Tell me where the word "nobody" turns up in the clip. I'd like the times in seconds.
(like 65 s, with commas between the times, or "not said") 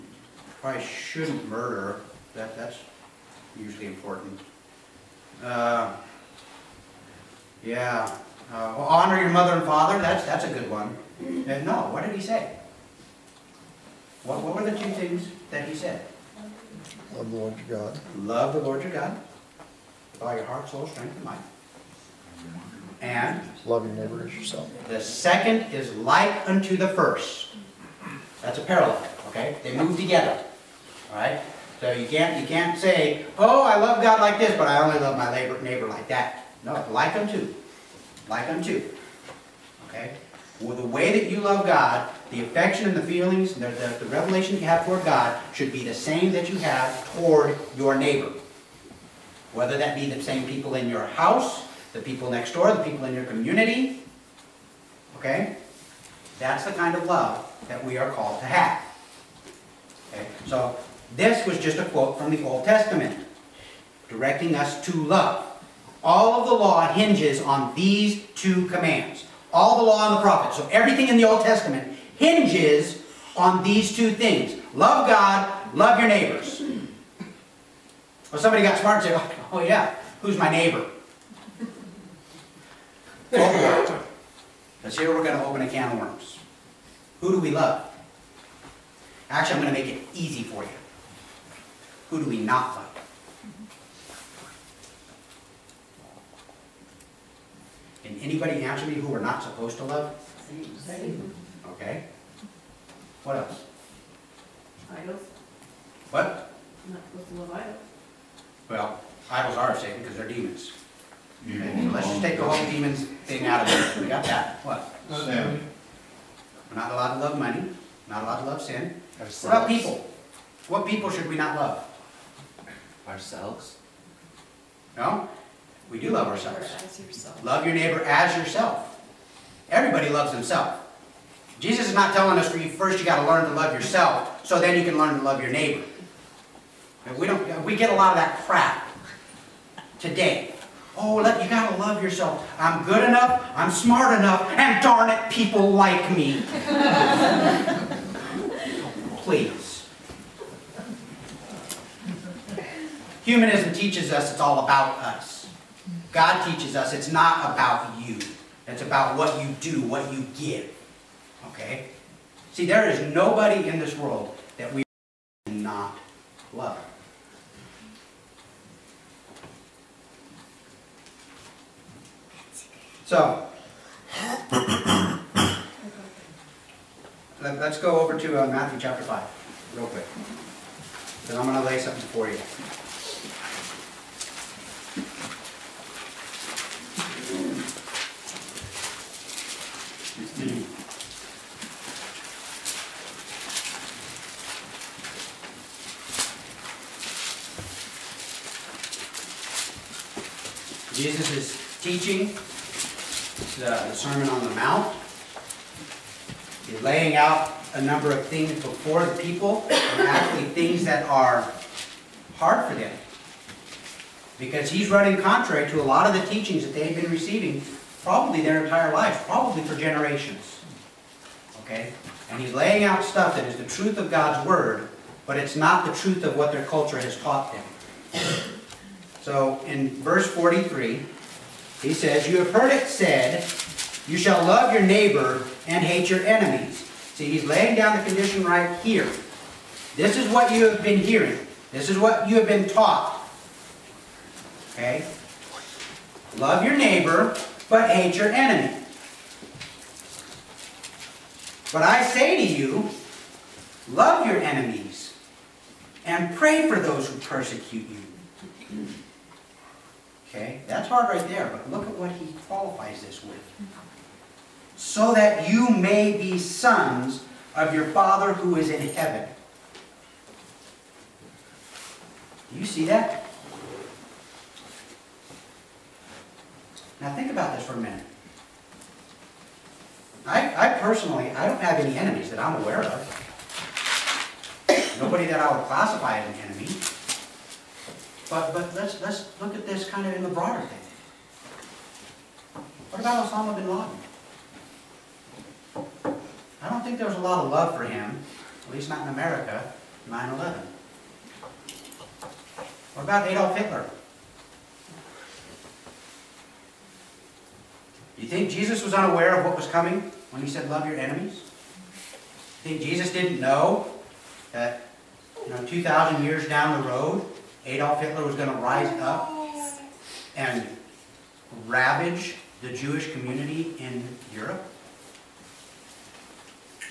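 163 s, 284 s.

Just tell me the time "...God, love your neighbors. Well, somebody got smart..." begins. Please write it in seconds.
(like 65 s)
75 s.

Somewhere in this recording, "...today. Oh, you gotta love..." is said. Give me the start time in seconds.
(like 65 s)
139 s.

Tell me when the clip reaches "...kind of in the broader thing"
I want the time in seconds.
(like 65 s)
289 s.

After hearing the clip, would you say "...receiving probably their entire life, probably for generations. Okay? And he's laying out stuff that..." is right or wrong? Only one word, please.
right.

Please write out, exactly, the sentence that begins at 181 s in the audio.
Then I'm going to lay something for you.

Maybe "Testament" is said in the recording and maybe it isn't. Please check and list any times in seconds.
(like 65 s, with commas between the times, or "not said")
62 s, 71 s.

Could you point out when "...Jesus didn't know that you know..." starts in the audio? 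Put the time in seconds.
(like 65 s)
312 s.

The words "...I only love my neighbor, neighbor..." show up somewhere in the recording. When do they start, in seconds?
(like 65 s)
34 s.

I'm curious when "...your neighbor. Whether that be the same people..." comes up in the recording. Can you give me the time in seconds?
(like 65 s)
47 s.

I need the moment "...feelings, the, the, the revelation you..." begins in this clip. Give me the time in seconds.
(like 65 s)
43 s.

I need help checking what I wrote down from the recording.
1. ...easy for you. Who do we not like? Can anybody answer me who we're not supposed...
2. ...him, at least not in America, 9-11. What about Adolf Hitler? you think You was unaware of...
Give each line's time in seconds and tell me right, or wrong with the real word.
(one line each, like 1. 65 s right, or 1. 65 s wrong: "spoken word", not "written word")
1. 90 s right
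2. 297 s wrong: "Jesus", not "You".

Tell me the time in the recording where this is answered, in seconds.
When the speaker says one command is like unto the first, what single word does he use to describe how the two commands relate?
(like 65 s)
28 s.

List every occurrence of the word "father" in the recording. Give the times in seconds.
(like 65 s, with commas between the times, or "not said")
9 s, 267 s.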